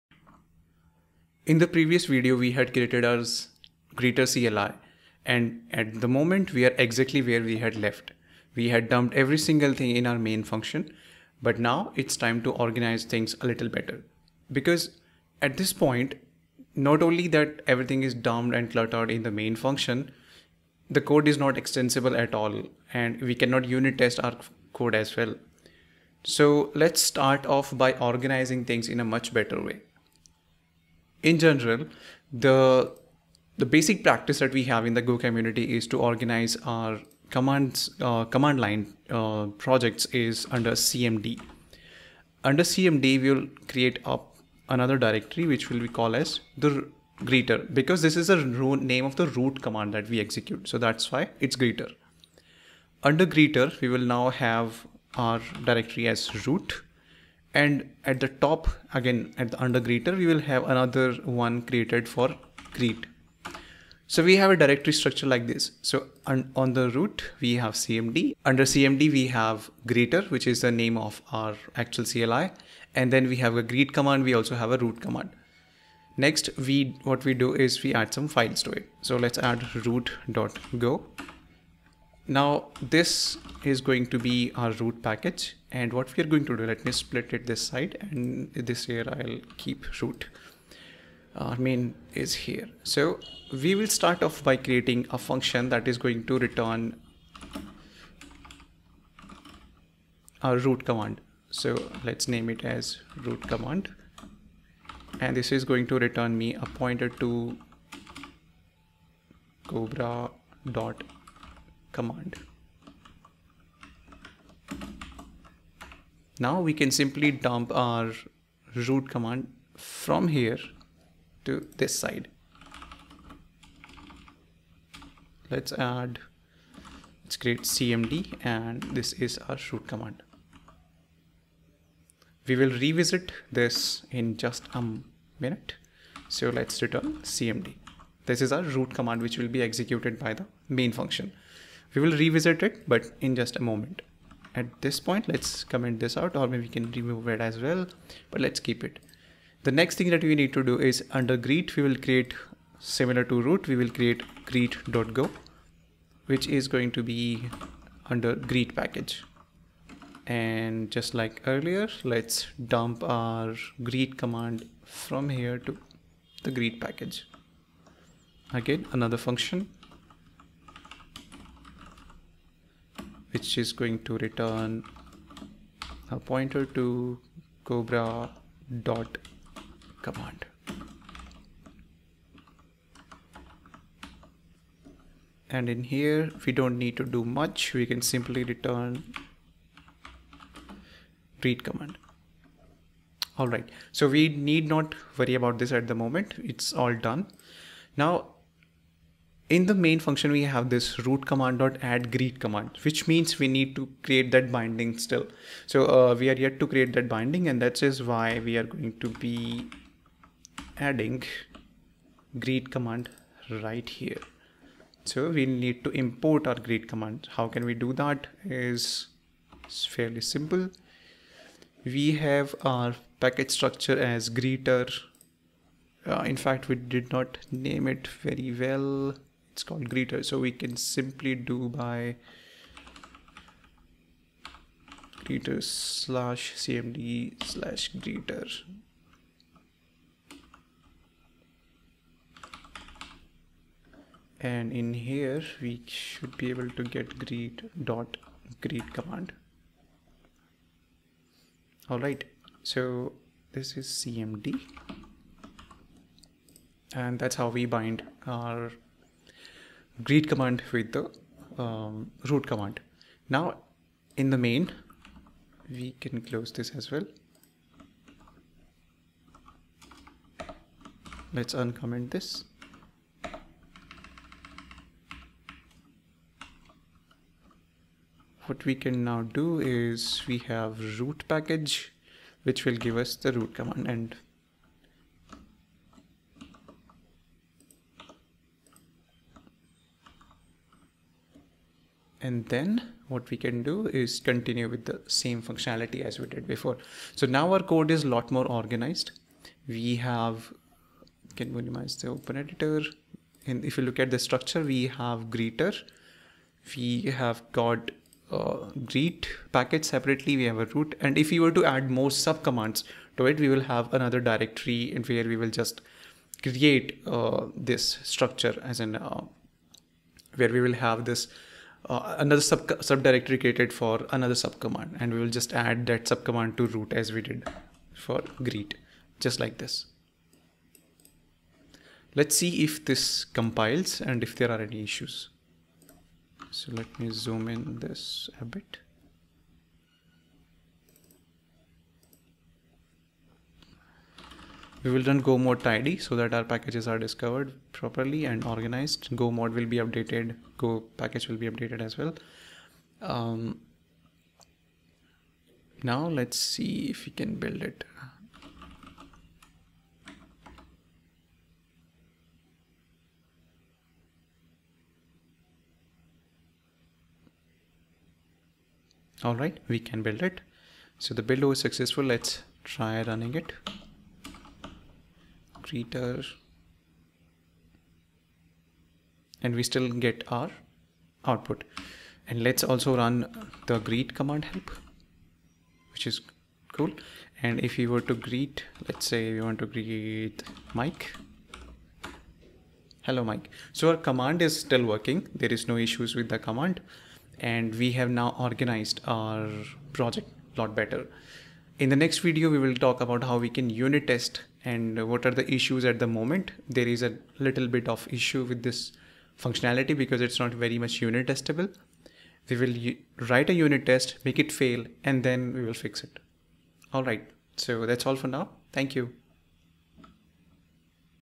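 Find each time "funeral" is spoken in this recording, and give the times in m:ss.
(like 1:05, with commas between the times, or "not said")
not said.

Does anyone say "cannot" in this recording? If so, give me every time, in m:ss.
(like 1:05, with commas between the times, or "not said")
0:23.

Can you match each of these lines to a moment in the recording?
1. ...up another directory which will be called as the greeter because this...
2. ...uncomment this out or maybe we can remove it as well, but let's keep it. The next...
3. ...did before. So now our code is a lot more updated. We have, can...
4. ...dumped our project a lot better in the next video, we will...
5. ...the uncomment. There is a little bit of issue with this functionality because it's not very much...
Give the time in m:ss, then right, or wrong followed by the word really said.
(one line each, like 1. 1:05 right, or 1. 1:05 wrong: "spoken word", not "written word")
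1. 0:44 right
2. 2:25 wrong: "comment", not "uncomment"
3. 4:56 wrong: "organized", not "updated"
4. 6:38 wrong: "organized", not "dumped"
5. 6:45 wrong: "moment", not "uncomment".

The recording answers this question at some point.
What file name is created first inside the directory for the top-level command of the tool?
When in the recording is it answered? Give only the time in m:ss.
1:19.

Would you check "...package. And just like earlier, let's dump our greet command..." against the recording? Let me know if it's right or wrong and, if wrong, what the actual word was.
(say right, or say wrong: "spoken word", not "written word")
right.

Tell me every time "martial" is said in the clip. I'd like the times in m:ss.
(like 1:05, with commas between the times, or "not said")
not said.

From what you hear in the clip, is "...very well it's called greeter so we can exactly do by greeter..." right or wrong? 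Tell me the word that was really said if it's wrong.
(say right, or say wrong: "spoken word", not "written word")
wrong: "simply", not "exactly".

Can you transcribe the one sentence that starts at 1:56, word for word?
Now we can simply dump our root command from here to this side.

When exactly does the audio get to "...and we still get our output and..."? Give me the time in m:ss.
6:19.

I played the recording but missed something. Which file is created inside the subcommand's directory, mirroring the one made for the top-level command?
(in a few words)
greet.go.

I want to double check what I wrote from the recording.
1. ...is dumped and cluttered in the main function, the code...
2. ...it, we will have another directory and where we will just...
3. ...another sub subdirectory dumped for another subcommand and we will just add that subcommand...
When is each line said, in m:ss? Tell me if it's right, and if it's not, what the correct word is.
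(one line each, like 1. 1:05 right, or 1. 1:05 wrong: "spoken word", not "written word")
1. 0:18 right
2. 5:13 right
3. 5:22 wrong: "created", not "dumped".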